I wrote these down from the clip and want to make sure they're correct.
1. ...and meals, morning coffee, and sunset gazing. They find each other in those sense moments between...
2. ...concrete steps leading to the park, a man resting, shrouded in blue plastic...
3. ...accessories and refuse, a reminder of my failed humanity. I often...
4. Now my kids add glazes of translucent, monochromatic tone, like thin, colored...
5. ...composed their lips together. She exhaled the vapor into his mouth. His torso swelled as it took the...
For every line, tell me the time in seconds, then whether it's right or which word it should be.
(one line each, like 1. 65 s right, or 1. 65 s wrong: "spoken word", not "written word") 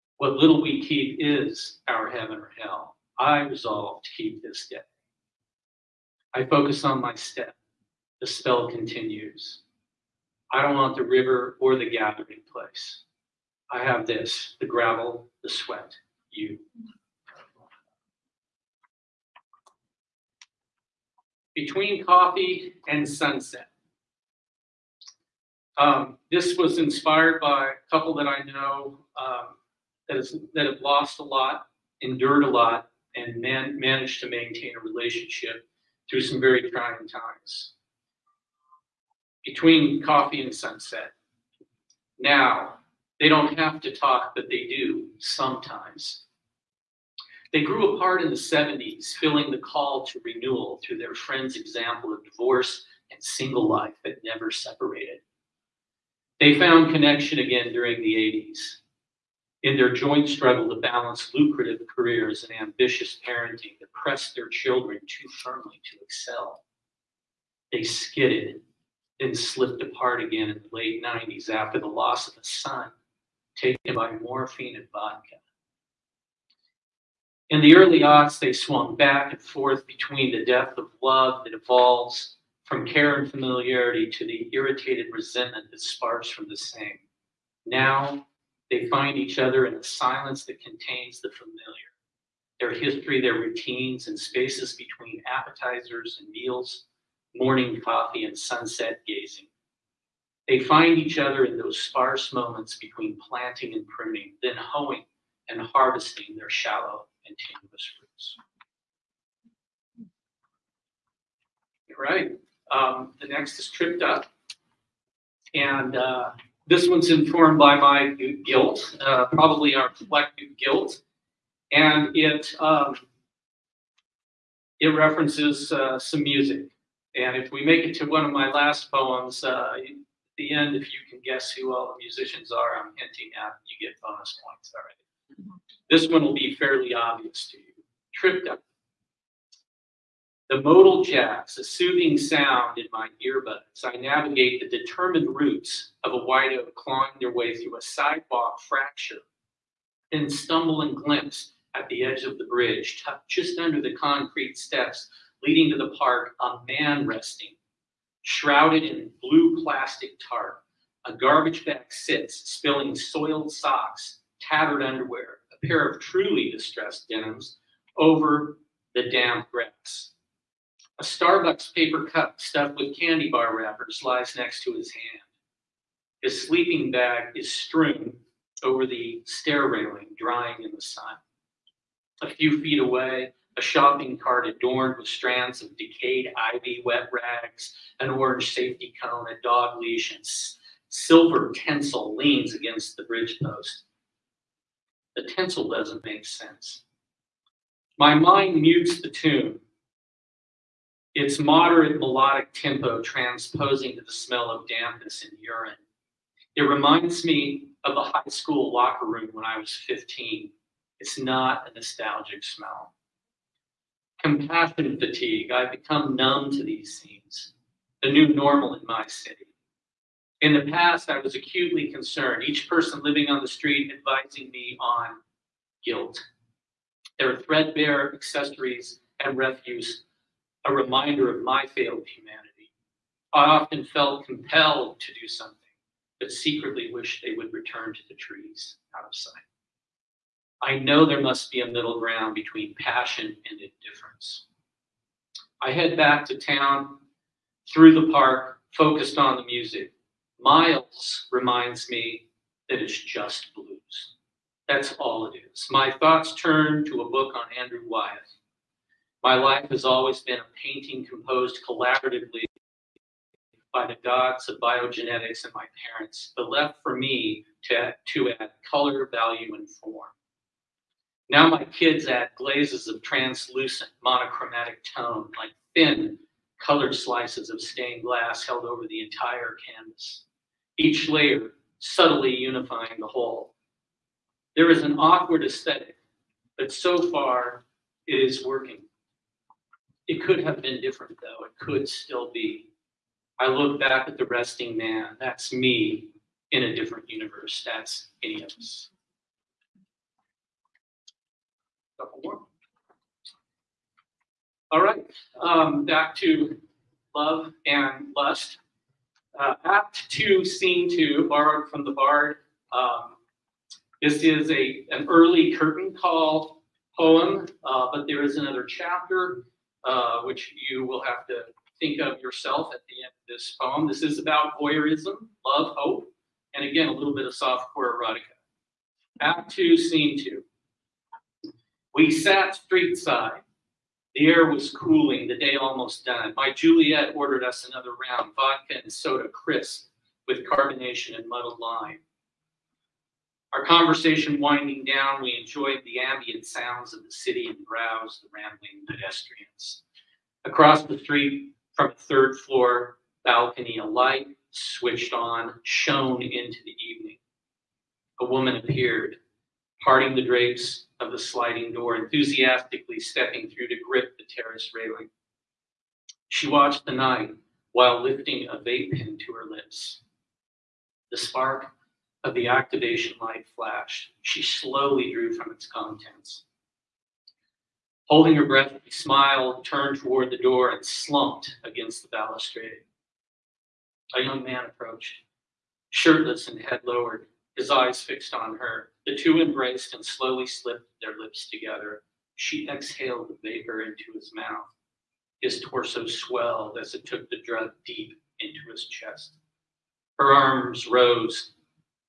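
1. 96 s wrong: "sparse", not "sense"
2. 153 s right
3. 228 s right
4. 271 s right
5. 390 s wrong: "slipped", not "composed".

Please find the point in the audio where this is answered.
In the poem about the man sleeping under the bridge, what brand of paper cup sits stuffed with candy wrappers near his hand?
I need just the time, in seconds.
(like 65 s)
171 s.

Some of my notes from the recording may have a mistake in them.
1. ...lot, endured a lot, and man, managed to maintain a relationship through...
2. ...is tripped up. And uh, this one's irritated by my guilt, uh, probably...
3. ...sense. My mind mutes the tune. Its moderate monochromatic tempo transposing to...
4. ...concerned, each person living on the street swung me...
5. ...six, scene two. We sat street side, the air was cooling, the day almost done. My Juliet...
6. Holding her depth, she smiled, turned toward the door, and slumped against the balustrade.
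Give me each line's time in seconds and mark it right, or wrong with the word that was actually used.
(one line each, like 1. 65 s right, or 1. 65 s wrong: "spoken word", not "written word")
1. 31 s right
2. 113 s wrong: "informed", not "irritated"
3. 196 s wrong: "melodic", not "monochromatic"
4. 221 s wrong: "advising", not "swung"
5. 329 s wrong: "two", not "six"
6. 378 s wrong: "breath", not "depth".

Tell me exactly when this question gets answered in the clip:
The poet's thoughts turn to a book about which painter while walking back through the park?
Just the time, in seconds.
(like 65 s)
257 s.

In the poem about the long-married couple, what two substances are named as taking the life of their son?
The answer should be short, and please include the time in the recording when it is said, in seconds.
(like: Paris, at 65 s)
Morphine and vodka, at 74 s.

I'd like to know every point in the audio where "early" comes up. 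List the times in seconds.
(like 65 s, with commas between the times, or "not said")
77 s, 315 s.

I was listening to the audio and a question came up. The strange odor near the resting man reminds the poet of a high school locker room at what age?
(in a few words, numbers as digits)
15.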